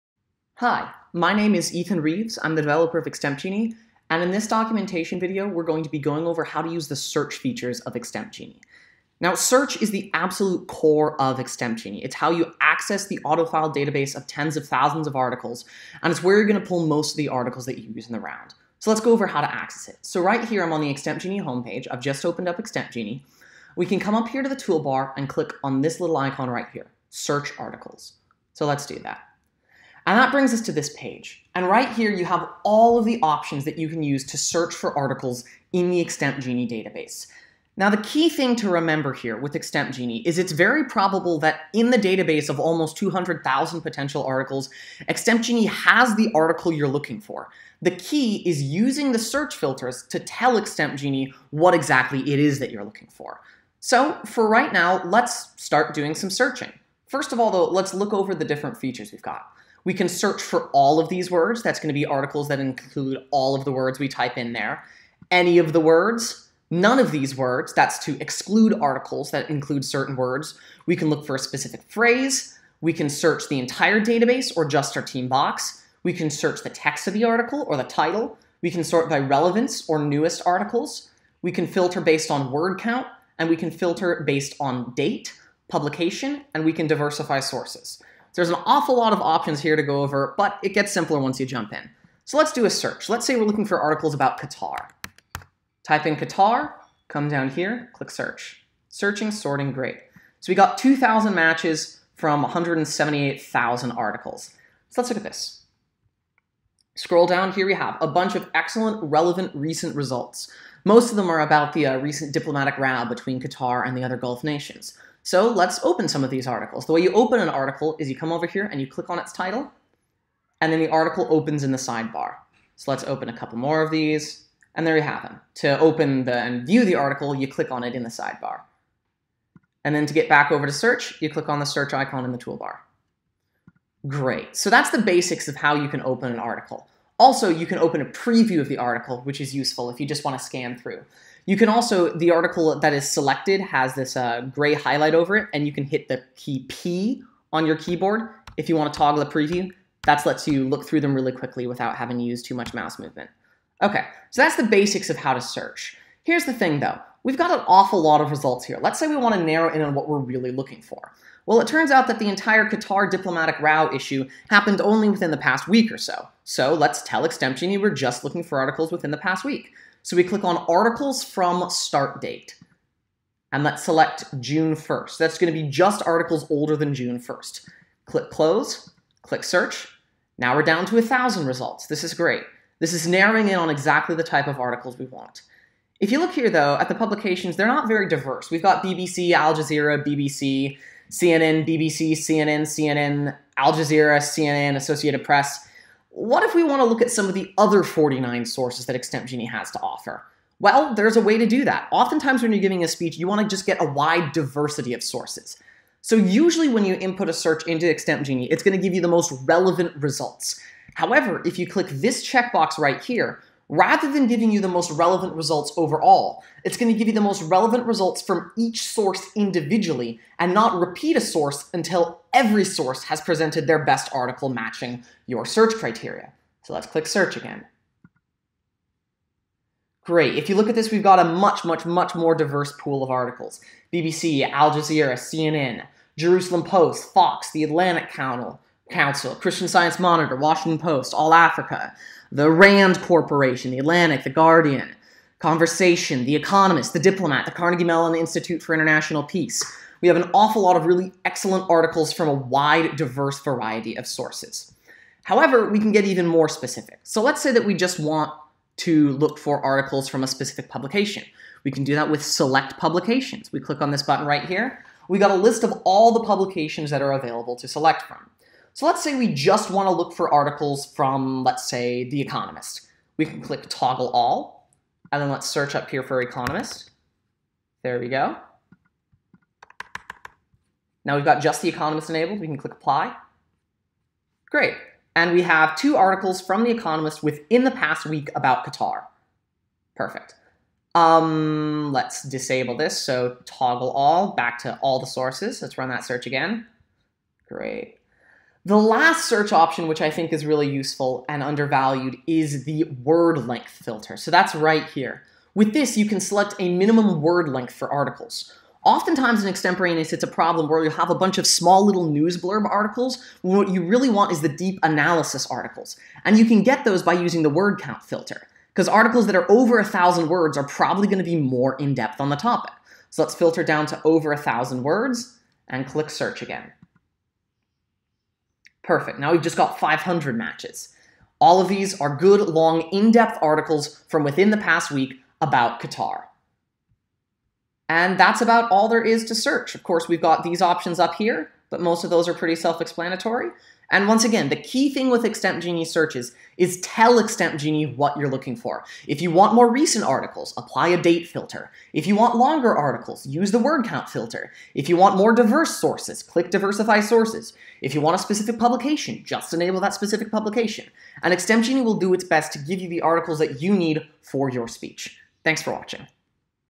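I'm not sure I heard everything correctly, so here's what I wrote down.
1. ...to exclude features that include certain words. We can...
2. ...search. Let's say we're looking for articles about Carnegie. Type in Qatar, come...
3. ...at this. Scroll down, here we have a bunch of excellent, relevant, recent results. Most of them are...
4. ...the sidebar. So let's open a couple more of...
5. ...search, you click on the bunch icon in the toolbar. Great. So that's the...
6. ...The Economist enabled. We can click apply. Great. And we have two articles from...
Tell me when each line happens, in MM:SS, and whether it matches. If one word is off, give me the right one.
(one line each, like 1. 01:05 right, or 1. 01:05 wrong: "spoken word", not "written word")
1. 01:08 wrong: "articles", not "features"
2. 01:32 wrong: "Qatar", not "Carnegie"
3. 01:45 right
4. 02:01 right
5. 02:10 wrong: "search", not "bunch"
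6. 04:41 right.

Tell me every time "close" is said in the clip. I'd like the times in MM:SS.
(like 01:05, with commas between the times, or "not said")
02:58.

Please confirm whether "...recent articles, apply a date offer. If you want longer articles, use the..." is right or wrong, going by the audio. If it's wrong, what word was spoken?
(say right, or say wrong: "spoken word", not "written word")
wrong: "filter", not "offer".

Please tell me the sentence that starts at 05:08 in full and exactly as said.
Oftentimes in extemporaneous, it's a problem where you have a bunch of small little news blurb articles.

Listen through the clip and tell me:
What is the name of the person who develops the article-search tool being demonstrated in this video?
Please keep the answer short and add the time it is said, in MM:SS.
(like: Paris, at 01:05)
Ethan Reeves, at 00:01.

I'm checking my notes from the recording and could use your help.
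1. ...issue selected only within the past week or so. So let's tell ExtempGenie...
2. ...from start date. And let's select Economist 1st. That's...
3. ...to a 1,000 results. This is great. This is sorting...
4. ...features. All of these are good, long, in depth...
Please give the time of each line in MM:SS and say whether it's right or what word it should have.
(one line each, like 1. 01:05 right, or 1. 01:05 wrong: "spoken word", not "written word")
1. 02:43 wrong: "happened", not "selected"
2. 02:51 wrong: "June", not "Economist"
3. 03:00 wrong: "narrowing", not "sorting"
4. 05:30 wrong: "matches", not "features".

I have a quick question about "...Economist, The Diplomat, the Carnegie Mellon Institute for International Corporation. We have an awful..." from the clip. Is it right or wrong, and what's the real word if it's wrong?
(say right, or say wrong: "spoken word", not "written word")
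wrong: "Peace", not "Corporation".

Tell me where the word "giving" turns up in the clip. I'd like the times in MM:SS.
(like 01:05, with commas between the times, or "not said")
03:22, 03:34.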